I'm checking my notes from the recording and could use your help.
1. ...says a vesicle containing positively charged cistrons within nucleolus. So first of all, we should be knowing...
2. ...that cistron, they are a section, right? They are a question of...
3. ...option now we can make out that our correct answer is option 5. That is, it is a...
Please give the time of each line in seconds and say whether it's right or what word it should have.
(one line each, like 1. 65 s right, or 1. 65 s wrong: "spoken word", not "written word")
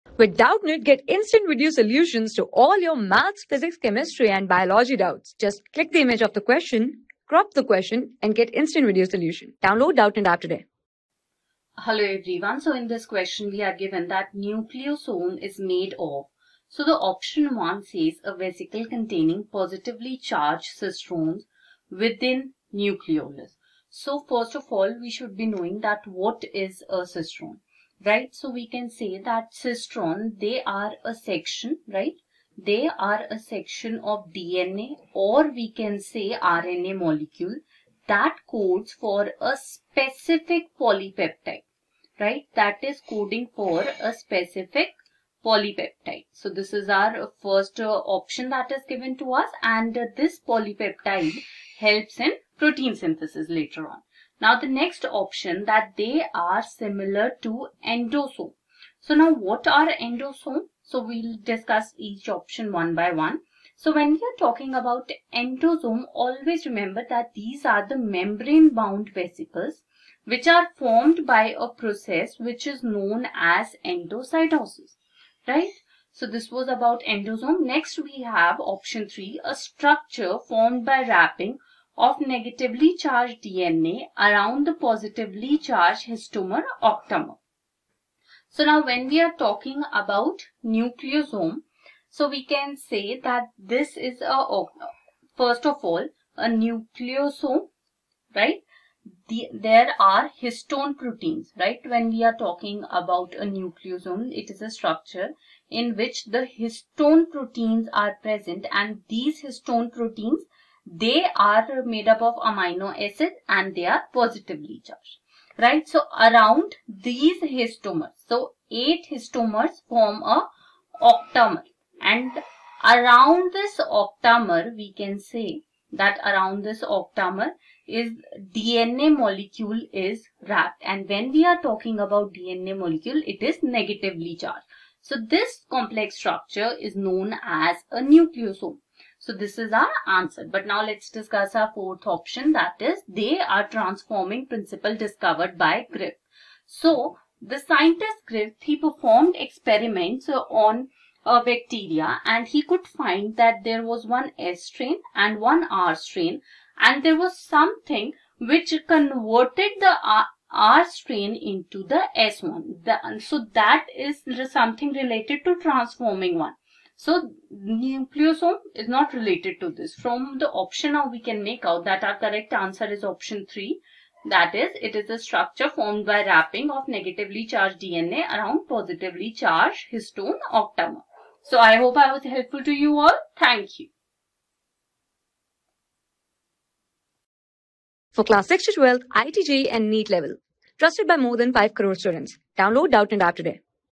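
1. 17 s right
2. 29 s wrong: "section", not "question"
3. 170 s wrong: "3", not "5".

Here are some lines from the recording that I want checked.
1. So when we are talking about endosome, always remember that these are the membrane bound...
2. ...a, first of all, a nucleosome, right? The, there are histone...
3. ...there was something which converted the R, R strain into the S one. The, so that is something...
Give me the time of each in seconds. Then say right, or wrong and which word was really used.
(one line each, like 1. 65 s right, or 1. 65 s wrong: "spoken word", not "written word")
1. 63 s right
2. 94 s right
3. 157 s right.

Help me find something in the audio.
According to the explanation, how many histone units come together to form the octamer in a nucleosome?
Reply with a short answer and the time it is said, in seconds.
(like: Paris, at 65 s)
8, at 118 s.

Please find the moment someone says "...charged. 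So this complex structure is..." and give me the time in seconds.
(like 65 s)
134 s.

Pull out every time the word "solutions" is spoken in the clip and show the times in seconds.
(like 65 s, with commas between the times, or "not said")
1 s, 9 s.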